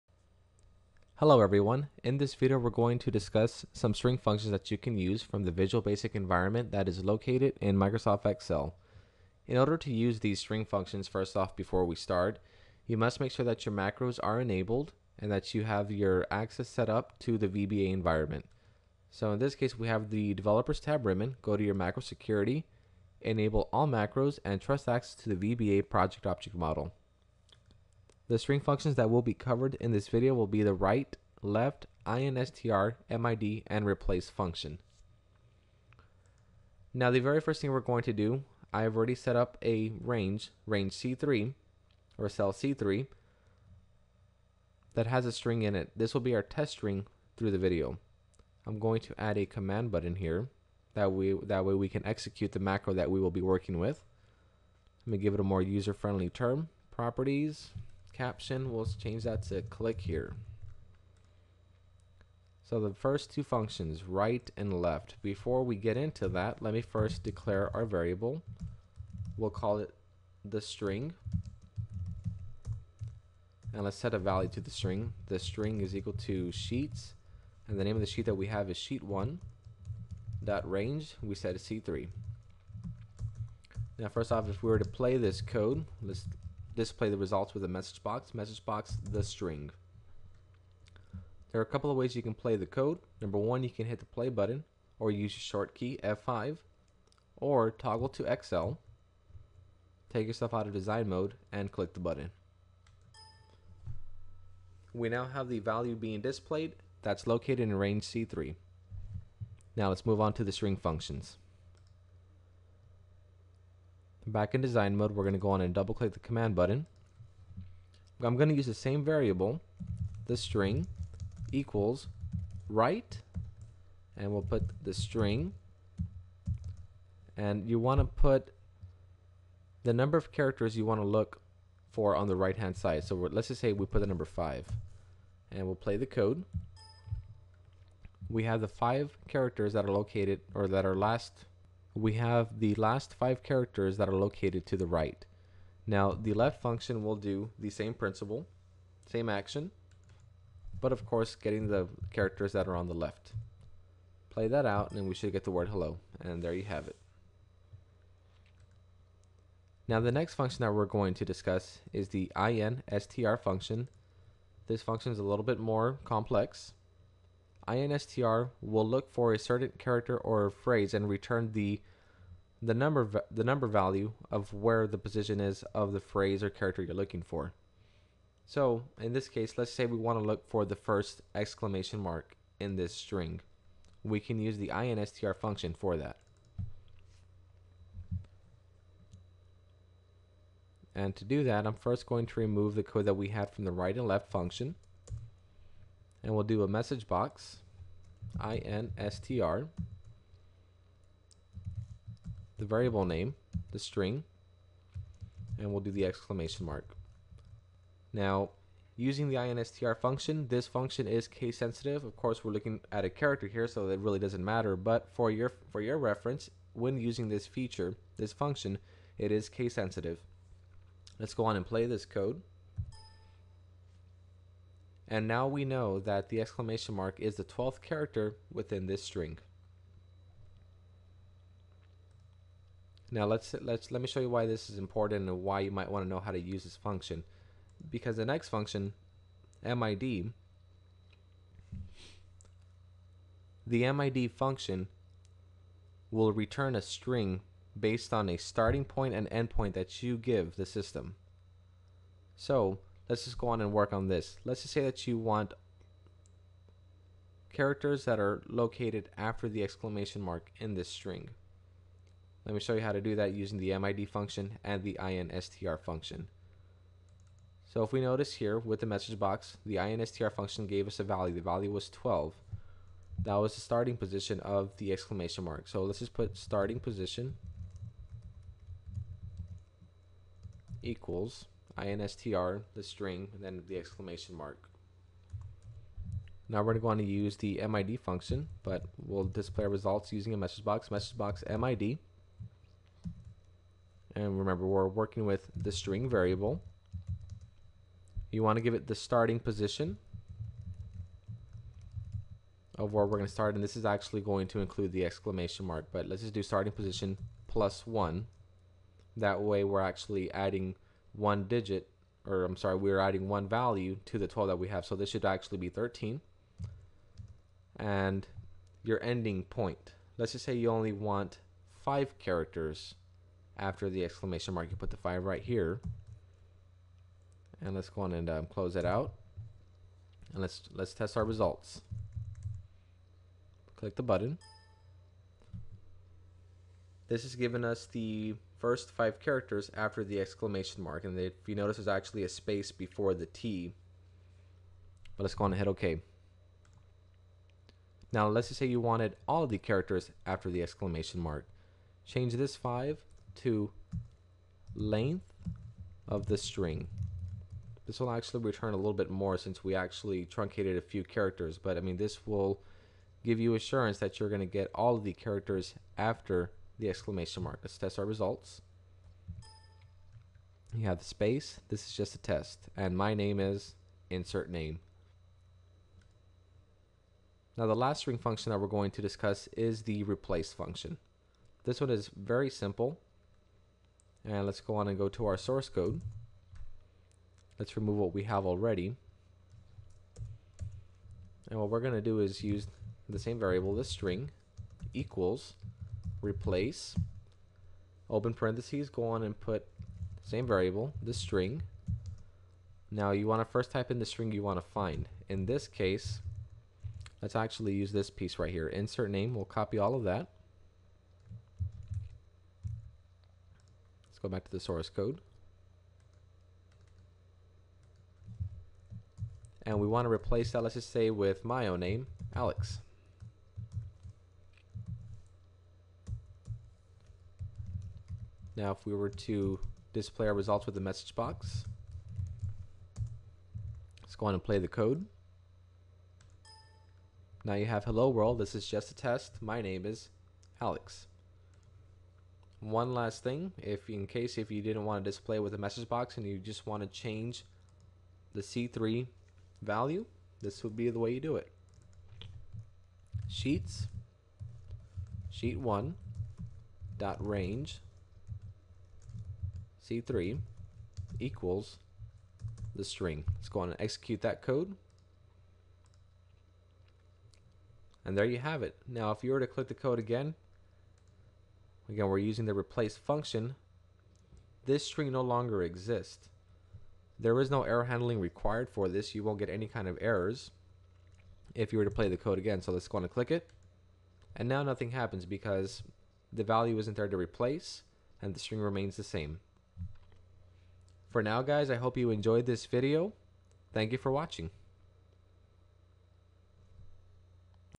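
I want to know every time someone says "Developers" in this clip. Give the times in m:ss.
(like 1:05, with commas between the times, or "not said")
0:20.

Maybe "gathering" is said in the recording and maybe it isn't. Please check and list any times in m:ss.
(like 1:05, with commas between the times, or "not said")
not said.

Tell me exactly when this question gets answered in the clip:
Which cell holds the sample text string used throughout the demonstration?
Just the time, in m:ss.
0:42.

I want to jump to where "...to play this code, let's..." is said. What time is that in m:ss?
1:24.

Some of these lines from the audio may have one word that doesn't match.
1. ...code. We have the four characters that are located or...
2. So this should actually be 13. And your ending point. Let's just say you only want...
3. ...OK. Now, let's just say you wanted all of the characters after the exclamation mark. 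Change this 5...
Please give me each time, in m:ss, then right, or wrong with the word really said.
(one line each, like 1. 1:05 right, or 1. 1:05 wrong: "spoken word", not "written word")
1. 2:16 wrong: "five", not "four"
2. 5:14 right
3. 5:45 right.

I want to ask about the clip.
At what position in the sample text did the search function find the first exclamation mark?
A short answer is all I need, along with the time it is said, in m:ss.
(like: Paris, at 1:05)
12, at 3:47.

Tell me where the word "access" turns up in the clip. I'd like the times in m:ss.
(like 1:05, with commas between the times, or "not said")
0:16, 0:24.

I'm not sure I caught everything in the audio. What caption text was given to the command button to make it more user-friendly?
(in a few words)
click here.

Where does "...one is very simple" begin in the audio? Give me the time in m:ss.
6:21.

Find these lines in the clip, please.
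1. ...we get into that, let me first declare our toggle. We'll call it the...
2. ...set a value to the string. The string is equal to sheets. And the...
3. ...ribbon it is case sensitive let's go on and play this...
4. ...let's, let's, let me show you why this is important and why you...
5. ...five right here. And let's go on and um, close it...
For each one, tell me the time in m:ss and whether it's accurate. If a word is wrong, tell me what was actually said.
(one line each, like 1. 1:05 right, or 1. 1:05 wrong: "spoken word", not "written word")
1. 1:05 wrong: "variable", not "toggle"
2. 1:13 right
3. 3:38 wrong: "function", not "ribbon"
4. 3:53 right
5. 5:24 right.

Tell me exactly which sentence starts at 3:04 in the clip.
We can use the instr function for that.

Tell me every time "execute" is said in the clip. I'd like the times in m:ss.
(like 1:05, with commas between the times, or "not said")
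0:52, 7:43.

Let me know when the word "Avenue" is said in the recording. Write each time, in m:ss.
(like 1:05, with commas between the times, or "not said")
not said.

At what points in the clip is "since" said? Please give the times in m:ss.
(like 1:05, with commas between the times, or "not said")
5:59.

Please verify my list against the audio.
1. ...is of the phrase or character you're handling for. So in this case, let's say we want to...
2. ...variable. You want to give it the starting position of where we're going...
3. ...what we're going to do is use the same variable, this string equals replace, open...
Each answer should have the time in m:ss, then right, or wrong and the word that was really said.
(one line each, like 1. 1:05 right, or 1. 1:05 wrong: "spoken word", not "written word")
1. 2:55 wrong: "looking", not "handling"
2. 4:56 right
3. 6:31 right.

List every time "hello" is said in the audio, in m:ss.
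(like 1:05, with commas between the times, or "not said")
0:01, 2:35, 7:17.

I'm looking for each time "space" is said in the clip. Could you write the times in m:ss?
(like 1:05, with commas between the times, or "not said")
5:42, 6:11.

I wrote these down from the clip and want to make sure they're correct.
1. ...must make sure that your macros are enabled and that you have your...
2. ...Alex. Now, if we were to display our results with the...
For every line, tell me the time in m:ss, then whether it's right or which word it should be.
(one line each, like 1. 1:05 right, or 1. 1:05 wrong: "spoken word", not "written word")
1. 0:12 right
2. 7:02 right.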